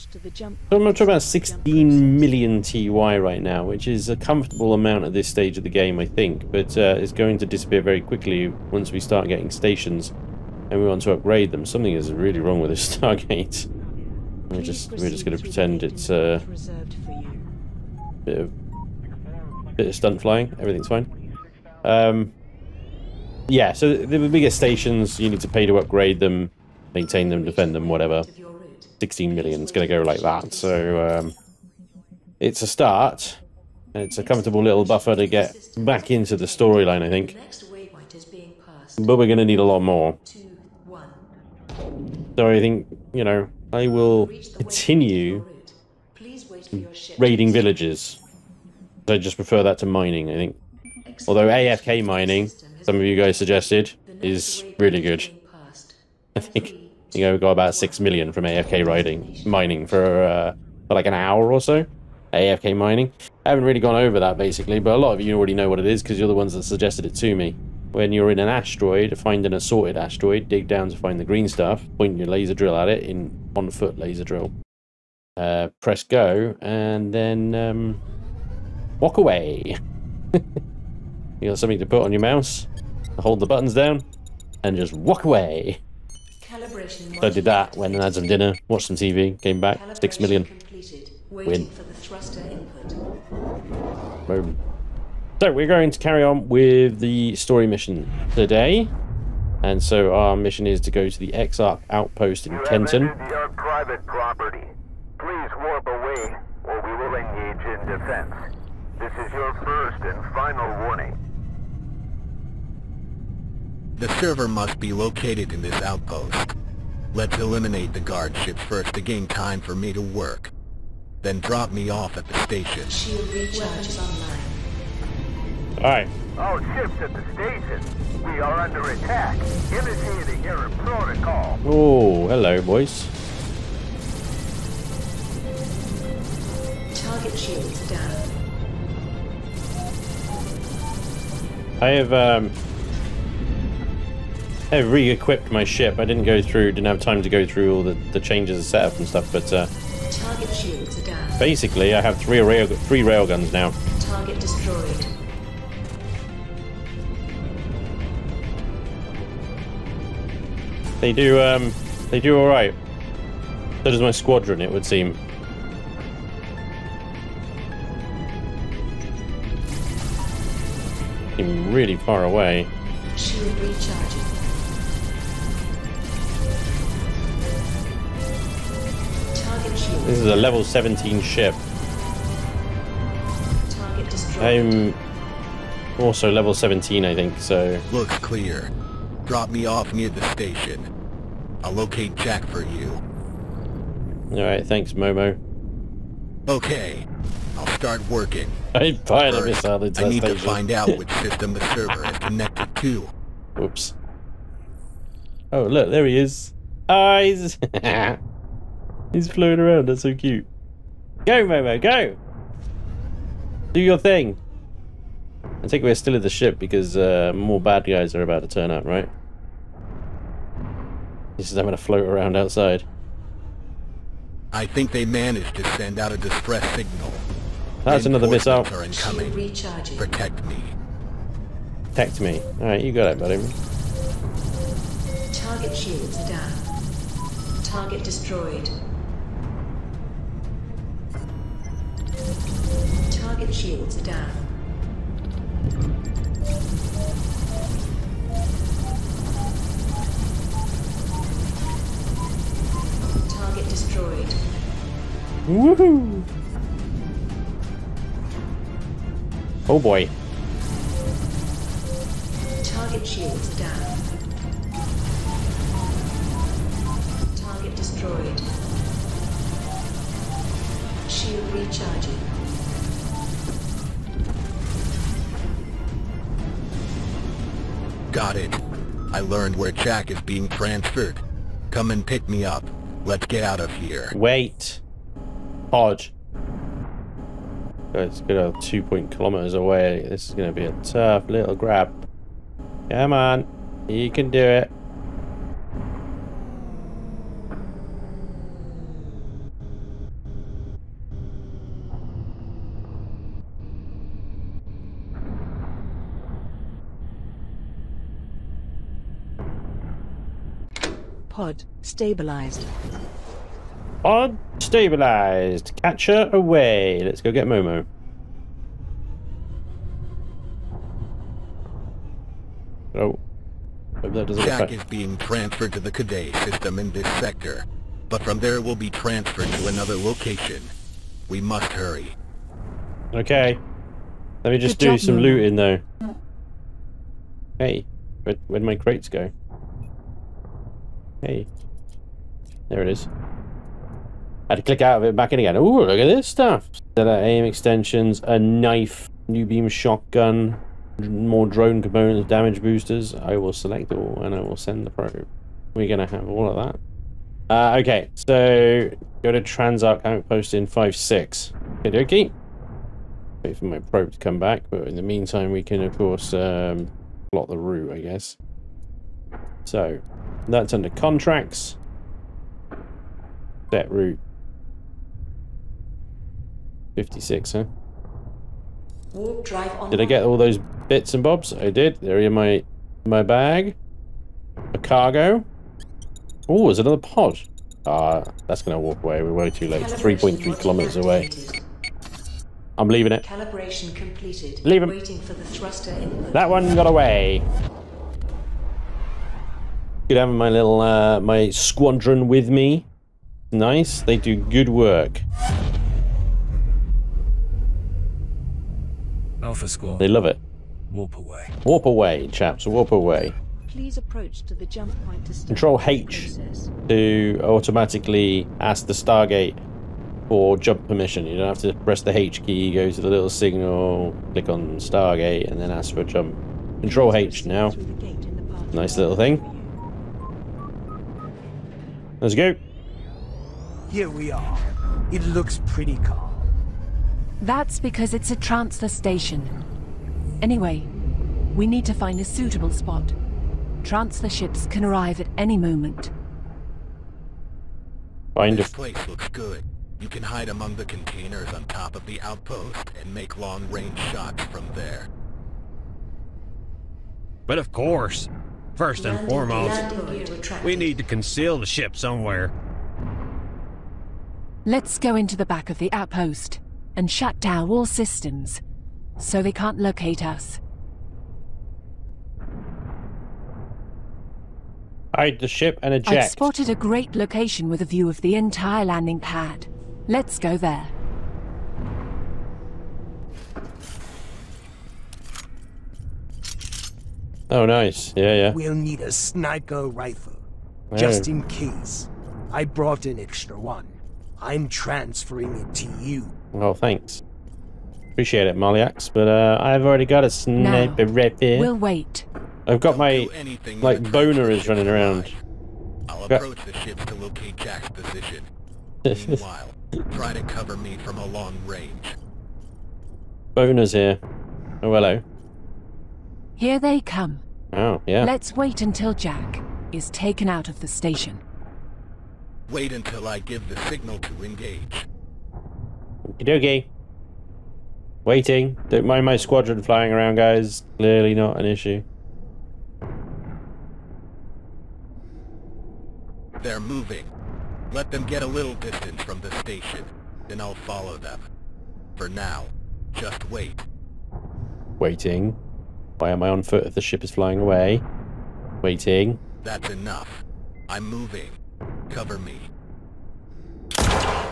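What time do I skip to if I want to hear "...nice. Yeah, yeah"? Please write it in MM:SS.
08:07.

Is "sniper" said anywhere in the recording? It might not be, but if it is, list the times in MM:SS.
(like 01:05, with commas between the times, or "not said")
08:09, 08:20.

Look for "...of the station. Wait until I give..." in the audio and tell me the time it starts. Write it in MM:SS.
08:40.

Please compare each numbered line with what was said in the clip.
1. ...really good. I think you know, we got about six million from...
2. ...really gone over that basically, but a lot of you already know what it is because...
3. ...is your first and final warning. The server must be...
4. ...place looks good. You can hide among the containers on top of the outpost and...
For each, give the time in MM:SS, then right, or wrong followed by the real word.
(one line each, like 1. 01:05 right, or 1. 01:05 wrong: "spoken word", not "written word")
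1. 00:54 right
2. 01:03 right
3. 01:49 right
4. 07:28 right.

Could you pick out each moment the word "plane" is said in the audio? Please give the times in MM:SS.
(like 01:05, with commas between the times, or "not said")
not said.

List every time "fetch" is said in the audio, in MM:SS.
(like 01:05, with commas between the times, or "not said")
not said.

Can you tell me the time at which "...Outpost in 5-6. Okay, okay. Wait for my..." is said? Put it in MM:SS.
06:00.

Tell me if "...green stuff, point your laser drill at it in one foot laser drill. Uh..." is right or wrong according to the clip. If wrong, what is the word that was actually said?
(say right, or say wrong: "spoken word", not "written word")
right.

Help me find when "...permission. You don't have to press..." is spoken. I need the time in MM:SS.
07:00.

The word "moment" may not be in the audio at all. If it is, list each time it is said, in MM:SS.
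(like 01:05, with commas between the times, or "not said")
07:25.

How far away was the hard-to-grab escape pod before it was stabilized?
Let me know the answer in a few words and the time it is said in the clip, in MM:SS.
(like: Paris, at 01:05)
two point kilometers, at 04:48.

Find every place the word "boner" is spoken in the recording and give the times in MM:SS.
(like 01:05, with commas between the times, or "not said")
08:24, 08:33.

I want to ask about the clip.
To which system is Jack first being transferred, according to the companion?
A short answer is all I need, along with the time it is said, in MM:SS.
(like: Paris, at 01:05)
Cadet, at 05:25.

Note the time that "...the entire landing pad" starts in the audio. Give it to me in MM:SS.
07:58.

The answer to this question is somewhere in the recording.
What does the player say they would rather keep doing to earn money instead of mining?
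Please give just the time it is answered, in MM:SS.
00:47.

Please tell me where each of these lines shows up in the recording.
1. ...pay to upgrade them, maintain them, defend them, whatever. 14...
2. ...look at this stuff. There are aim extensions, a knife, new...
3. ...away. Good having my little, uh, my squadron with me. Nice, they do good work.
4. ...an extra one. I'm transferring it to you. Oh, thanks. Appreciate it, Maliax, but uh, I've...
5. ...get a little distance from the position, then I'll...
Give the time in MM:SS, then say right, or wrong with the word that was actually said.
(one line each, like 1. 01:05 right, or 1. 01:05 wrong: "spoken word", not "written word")
1. 00:25 wrong: "16", not "14"
2. 05:45 right
3. 06:36 right
4. 08:13 right
5. 08:58 wrong: "station", not "position".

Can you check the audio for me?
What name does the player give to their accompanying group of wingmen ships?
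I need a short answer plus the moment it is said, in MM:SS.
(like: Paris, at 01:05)
Alpha Squad, at 06:49.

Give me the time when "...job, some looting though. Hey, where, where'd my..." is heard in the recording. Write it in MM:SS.
05:34.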